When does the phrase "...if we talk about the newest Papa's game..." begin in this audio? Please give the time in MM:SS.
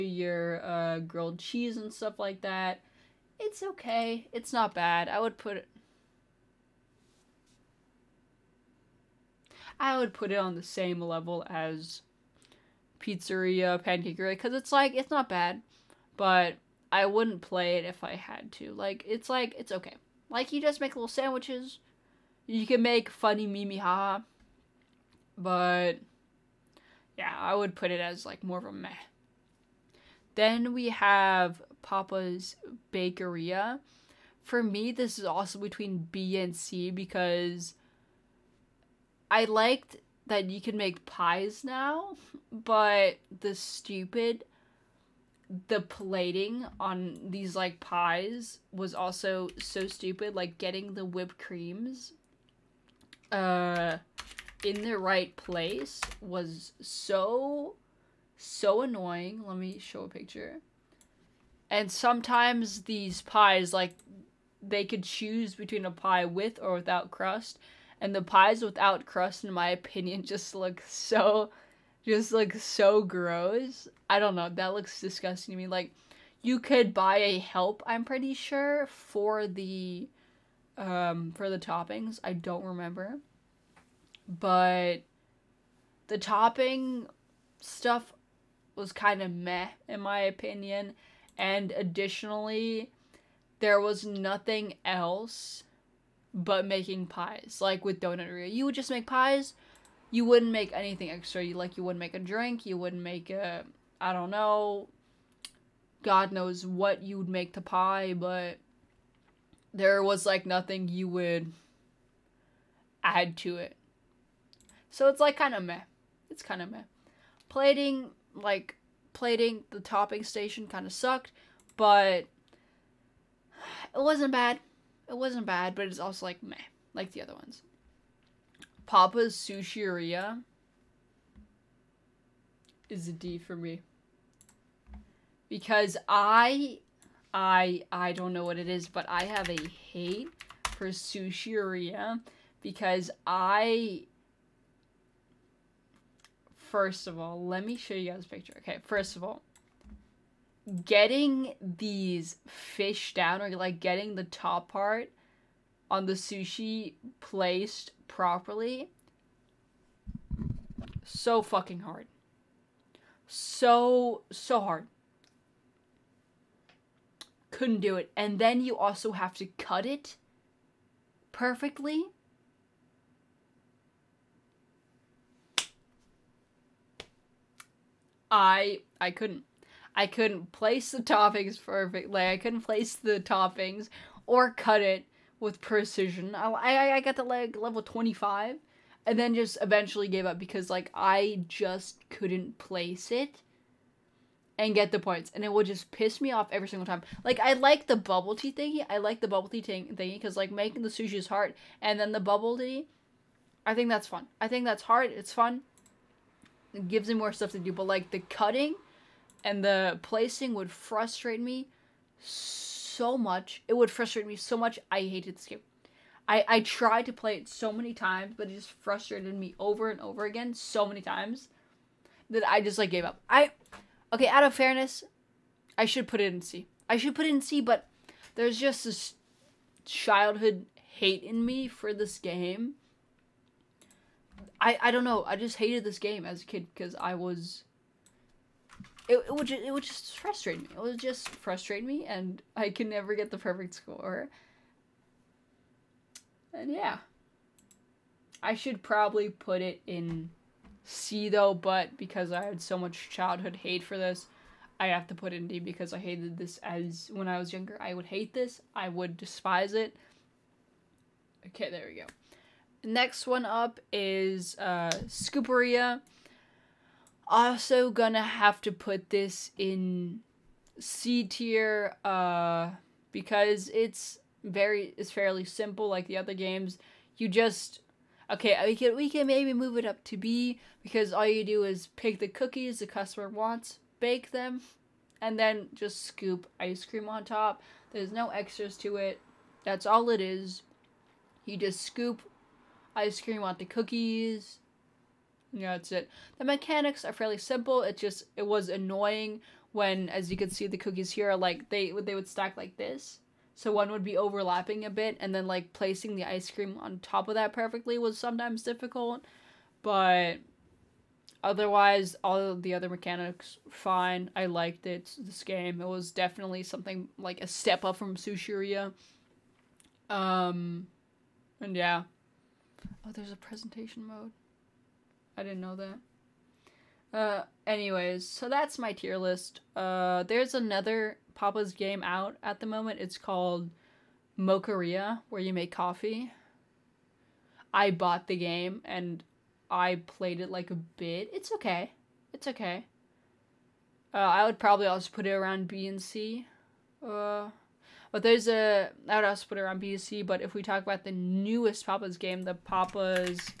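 05:50.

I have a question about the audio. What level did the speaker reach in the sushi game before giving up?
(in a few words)
25.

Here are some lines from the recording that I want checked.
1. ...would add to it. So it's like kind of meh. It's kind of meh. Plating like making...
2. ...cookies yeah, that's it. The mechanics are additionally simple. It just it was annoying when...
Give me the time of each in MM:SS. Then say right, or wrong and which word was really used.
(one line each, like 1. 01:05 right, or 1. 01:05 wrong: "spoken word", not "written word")
1. 01:51 wrong: "plating", not "making"
2. 04:53 wrong: "fairly", not "additionally".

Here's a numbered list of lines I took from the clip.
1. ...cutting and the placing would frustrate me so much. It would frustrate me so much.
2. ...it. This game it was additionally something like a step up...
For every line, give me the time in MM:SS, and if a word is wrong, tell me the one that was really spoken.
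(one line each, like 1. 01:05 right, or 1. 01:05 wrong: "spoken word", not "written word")
1. 03:28 right
2. 05:14 wrong: "definitely", not "additionally".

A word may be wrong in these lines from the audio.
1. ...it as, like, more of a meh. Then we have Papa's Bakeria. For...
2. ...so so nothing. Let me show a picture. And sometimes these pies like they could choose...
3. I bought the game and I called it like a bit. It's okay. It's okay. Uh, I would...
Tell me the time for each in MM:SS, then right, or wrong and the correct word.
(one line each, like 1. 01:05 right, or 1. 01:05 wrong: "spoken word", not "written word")
1. 00:27 right
2. 00:56 wrong: "annoying", not "nothing"
3. 05:37 wrong: "played", not "called".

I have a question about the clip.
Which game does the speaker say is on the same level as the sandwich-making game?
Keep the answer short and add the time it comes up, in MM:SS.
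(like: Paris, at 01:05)
Pizzeria, at 00:13.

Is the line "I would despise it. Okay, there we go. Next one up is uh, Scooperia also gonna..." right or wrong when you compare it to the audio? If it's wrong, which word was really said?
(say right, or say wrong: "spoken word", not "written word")
right.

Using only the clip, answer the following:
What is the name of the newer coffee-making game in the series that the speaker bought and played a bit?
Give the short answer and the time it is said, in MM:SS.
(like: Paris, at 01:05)
Mocharia, at 05:34.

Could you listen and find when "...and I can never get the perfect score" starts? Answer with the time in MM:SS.
04:02.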